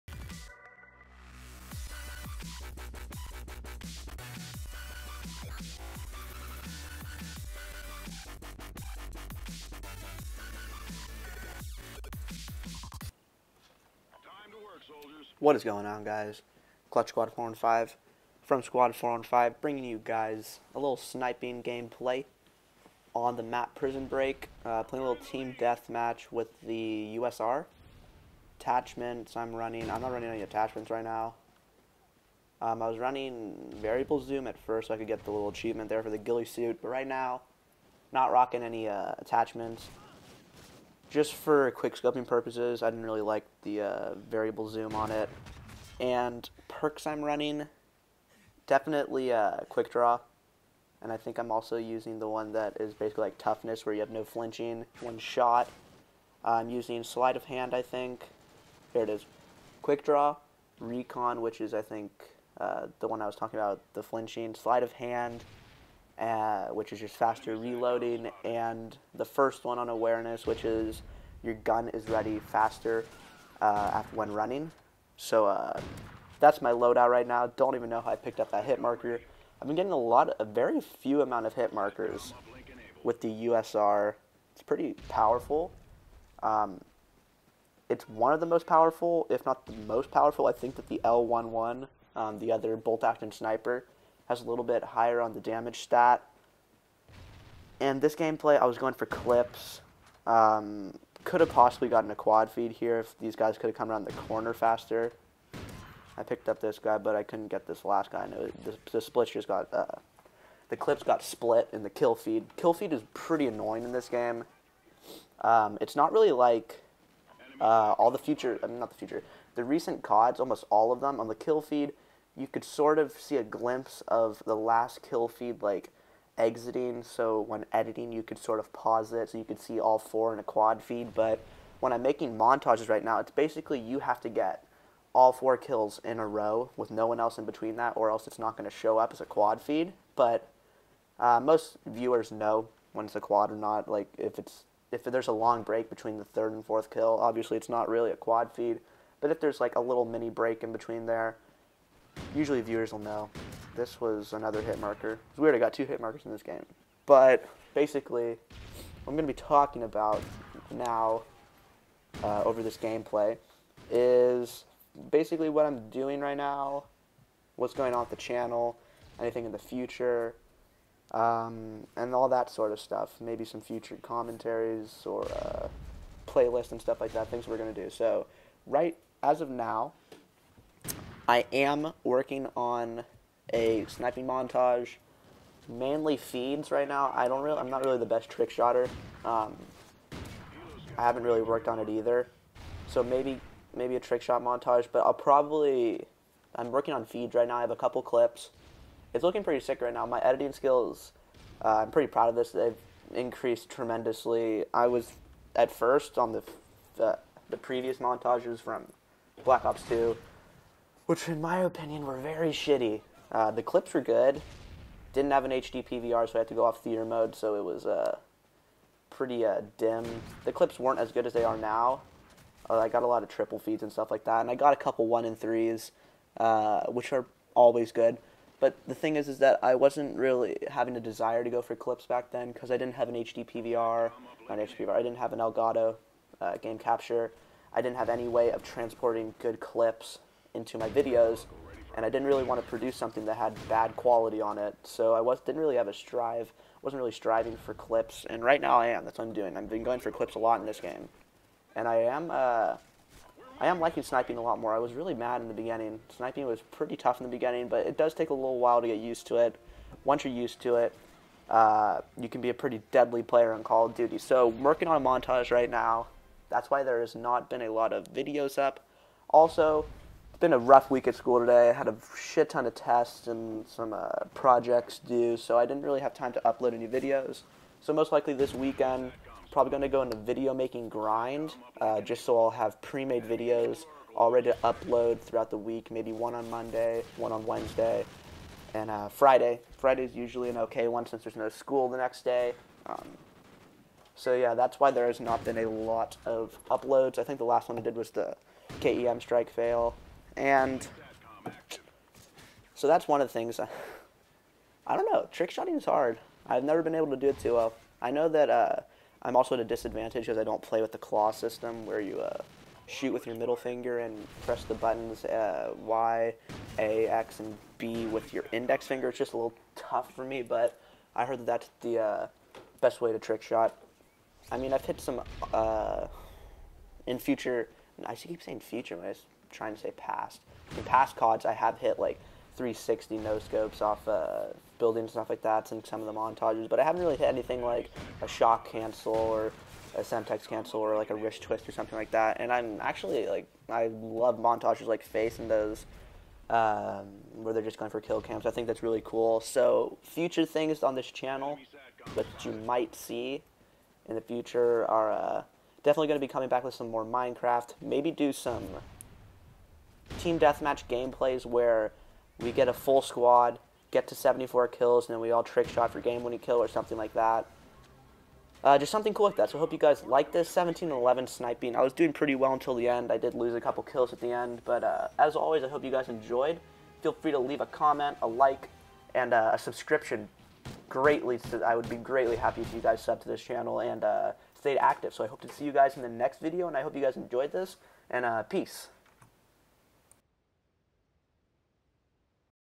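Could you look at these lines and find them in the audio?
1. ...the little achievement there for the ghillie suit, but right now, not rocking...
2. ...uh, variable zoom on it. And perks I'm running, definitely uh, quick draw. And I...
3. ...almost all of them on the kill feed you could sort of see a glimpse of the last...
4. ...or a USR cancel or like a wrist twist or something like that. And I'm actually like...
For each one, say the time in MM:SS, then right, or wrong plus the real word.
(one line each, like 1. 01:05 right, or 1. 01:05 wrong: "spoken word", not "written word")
1. 00:35 right
2. 00:43 right
3. 02:00 right
4. 05:39 wrong: "Semtex", not "USR".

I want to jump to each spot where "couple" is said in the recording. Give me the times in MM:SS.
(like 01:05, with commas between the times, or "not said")
03:17, 03:44, 06:13.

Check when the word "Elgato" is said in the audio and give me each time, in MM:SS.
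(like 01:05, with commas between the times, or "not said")
03:55.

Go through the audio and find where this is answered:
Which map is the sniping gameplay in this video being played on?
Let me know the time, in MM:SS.
00:23.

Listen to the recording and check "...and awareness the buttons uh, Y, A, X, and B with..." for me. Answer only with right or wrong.
wrong.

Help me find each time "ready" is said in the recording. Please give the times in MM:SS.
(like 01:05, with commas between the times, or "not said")
01:12, 04:44.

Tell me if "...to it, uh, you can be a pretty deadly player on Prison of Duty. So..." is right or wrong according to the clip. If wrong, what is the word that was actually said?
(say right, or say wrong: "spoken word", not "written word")
wrong: "Call", not "Prison".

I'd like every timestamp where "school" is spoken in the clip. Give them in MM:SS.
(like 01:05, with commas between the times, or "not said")
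04:31, 04:51.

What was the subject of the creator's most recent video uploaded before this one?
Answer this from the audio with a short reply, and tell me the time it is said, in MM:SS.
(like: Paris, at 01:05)
KEM strike fail, at 04:58.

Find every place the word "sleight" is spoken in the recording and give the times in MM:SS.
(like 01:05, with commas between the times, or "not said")
00:57, 01:04.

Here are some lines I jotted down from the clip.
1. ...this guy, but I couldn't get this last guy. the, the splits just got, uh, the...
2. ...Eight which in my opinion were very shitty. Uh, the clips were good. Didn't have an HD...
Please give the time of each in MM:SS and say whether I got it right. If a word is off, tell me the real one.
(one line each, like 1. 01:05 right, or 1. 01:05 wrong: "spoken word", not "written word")
1. 01:46 right
2. 03:29 wrong: "Two", not "Eight".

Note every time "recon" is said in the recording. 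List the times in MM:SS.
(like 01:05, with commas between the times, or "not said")
01:00.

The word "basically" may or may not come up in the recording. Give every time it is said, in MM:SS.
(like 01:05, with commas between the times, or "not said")
00:52, 02:13, 02:37, 02:45.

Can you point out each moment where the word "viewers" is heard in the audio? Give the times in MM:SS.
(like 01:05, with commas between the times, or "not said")
02:21, 02:32.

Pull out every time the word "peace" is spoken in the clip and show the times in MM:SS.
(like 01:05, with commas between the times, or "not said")
06:28.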